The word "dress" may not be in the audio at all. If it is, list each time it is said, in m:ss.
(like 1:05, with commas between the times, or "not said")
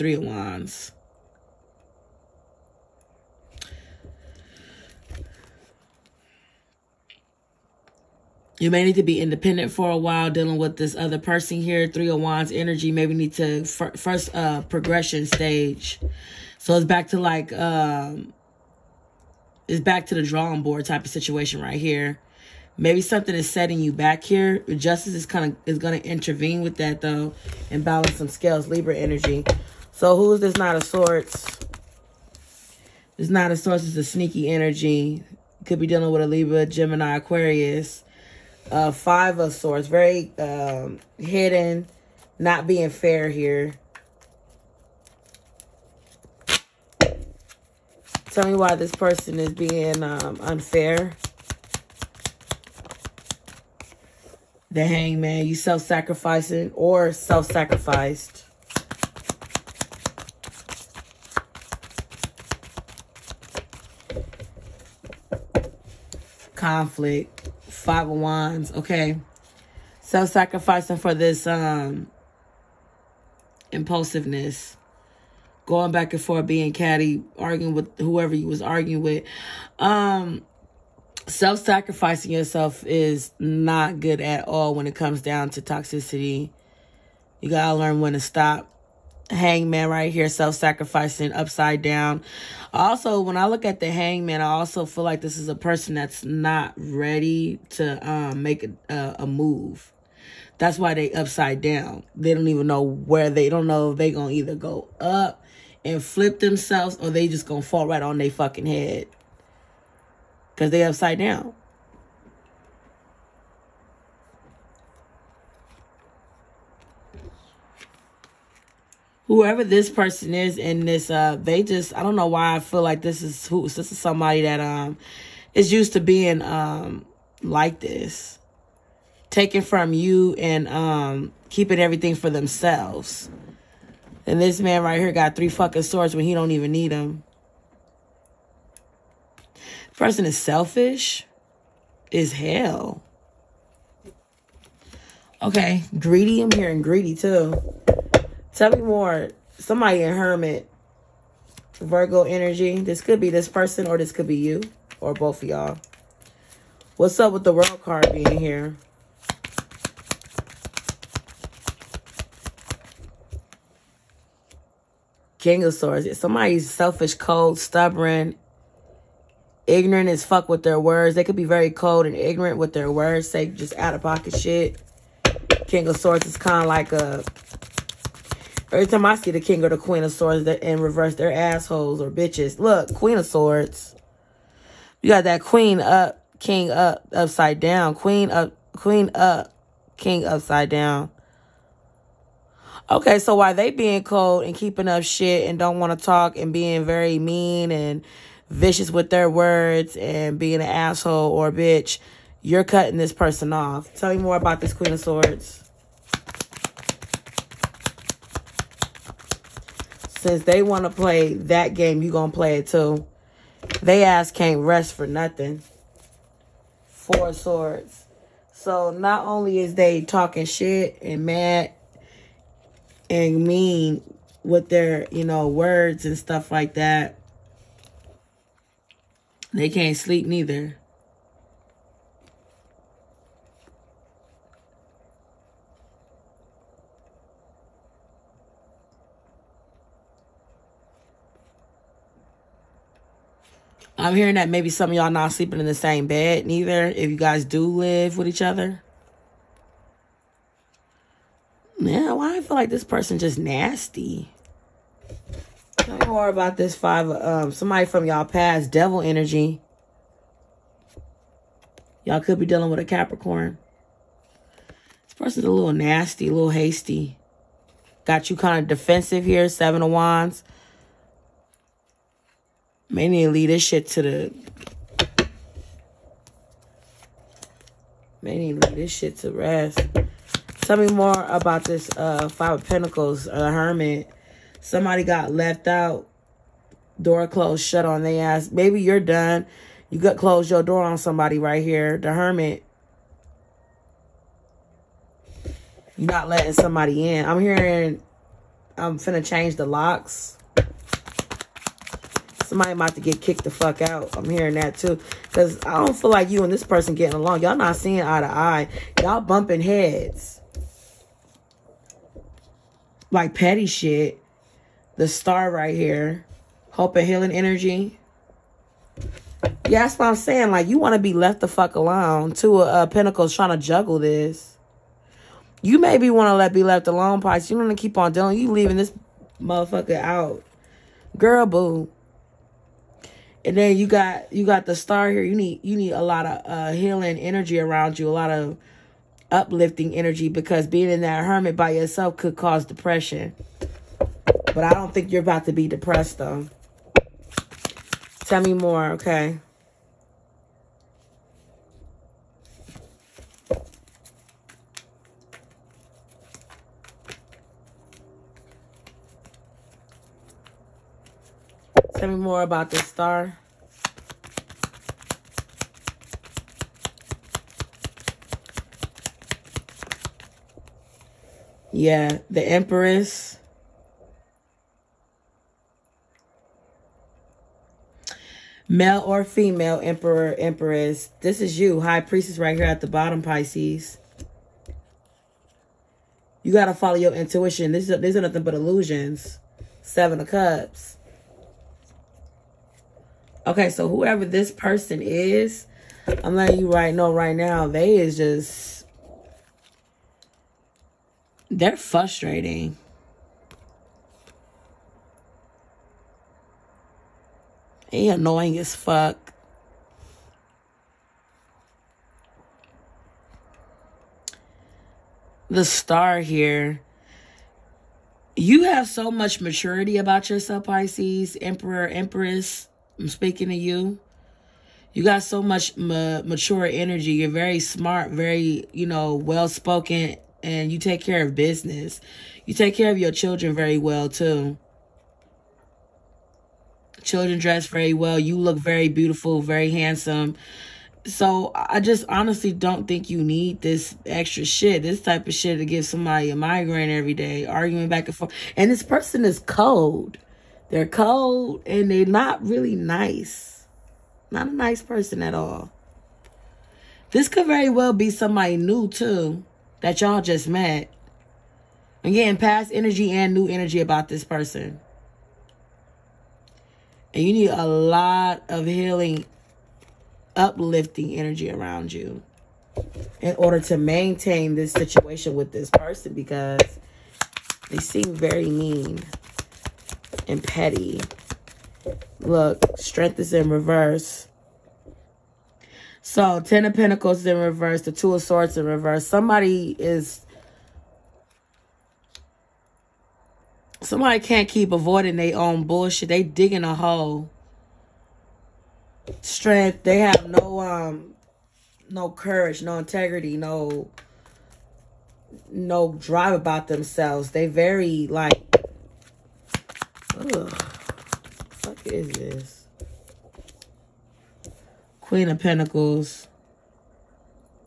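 7:17.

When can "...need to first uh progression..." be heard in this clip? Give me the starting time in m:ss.
0:13.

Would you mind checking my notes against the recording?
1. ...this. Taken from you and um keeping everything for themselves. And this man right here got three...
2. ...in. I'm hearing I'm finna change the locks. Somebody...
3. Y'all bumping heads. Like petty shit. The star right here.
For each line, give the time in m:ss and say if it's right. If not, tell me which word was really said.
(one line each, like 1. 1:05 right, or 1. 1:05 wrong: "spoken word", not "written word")
1. 2:07 right
2. 4:57 right
3. 5:09 right.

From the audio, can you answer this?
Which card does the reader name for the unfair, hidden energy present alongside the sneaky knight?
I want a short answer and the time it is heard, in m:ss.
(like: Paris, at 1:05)
Five of Swords, at 0:38.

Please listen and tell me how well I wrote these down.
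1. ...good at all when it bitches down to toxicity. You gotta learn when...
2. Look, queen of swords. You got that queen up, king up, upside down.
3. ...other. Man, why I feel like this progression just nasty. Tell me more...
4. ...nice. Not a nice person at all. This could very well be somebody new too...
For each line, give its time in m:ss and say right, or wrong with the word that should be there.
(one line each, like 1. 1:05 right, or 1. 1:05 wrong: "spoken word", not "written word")
1. 1:24 wrong: "comes", not "bitches"
2. 3:02 right
3. 4:08 wrong: "person", not "progression"
4. 7:32 right.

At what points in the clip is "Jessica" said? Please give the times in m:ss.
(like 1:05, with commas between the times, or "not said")
not said.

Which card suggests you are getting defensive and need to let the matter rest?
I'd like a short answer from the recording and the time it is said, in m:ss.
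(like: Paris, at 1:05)
Seven of Wands, at 4:29.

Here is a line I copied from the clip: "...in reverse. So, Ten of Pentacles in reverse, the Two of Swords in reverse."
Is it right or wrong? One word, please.
right.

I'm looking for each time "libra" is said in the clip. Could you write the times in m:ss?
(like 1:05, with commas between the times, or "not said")
0:28, 0:36.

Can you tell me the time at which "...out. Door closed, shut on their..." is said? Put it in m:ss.
4:45.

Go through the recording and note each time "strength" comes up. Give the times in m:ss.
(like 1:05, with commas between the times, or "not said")
8:02, 8:19.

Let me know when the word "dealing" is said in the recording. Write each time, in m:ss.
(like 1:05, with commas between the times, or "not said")
0:10, 0:35, 4:22, 5:28.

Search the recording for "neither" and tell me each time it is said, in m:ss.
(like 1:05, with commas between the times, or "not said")
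3:50, 4:06.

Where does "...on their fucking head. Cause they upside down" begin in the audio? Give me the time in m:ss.
1:48.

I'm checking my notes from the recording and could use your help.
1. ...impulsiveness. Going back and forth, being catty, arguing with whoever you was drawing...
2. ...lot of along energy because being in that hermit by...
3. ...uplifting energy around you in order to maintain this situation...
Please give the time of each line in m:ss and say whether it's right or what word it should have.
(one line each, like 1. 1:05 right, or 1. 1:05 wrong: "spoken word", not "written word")
1. 1:13 wrong: "arguing", not "drawing"
2. 5:38 wrong: "uplifting", not "along"
3. 7:50 right.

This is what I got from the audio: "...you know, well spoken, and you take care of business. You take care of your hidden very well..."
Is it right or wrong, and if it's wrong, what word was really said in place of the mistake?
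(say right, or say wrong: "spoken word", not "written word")
wrong: "children", not "hidden".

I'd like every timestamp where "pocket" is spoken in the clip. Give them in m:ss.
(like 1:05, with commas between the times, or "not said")
2:54.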